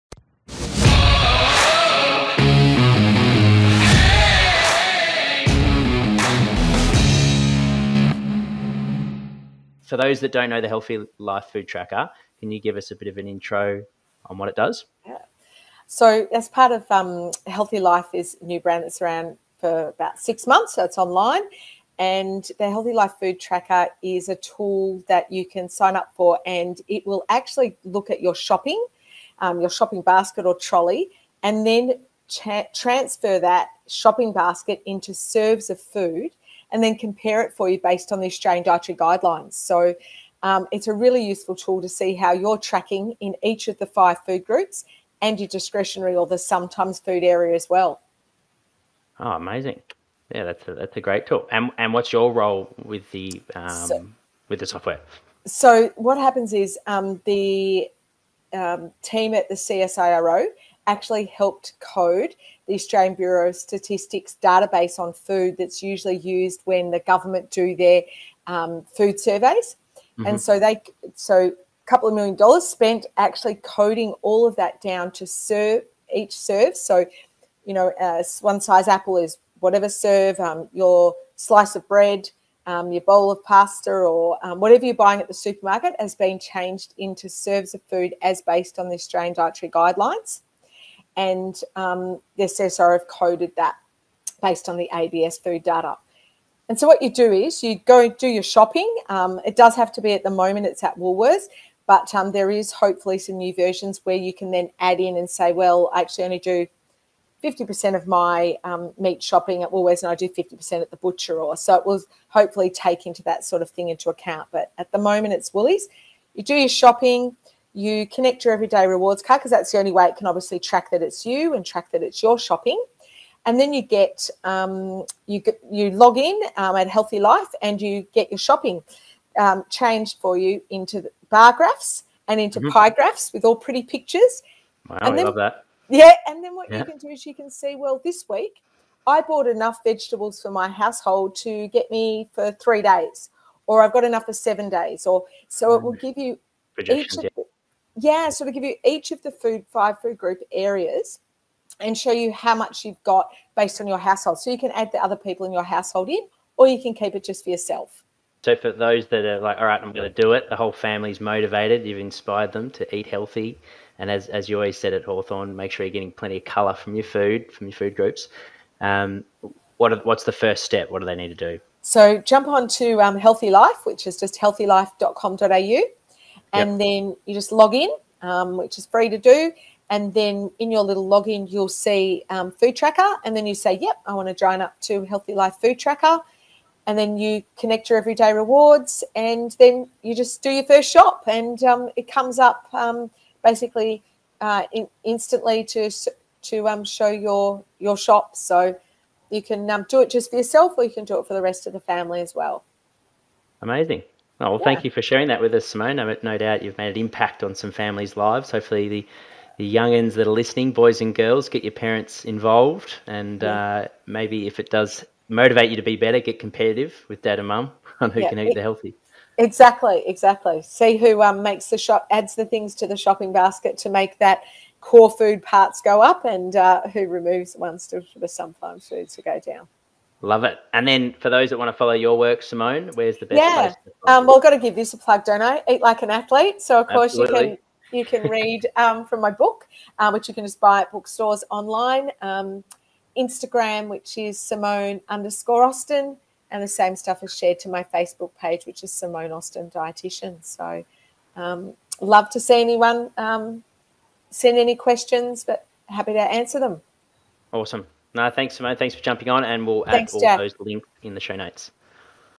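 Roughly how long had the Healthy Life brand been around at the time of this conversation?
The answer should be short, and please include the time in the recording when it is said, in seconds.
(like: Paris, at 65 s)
6 months, at 20 s.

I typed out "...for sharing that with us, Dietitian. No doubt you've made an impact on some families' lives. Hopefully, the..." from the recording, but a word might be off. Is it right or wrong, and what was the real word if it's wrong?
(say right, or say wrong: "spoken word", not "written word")
wrong: "Simone", not "Dietitian".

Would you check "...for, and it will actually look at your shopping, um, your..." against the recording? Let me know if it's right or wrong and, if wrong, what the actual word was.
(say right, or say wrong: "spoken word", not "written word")
right.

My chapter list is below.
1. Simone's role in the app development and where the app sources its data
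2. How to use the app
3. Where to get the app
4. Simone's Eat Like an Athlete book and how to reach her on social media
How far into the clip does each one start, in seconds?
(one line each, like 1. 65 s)
1. 51 s
2. 98 s
3. 170 s
4. 231 s.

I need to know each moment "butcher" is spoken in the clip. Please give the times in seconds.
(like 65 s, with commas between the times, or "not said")
110 s.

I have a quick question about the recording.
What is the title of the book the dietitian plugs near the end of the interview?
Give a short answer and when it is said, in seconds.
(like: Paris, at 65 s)
Eat Like an Athlete, at 235 s.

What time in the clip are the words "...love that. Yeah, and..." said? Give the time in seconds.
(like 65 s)
135 s.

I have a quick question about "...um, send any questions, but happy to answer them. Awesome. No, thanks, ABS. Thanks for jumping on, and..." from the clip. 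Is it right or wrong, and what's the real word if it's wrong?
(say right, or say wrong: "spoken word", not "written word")
wrong: "Simone", not "ABS".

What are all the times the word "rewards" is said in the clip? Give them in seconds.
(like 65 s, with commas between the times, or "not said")
118 s, 188 s.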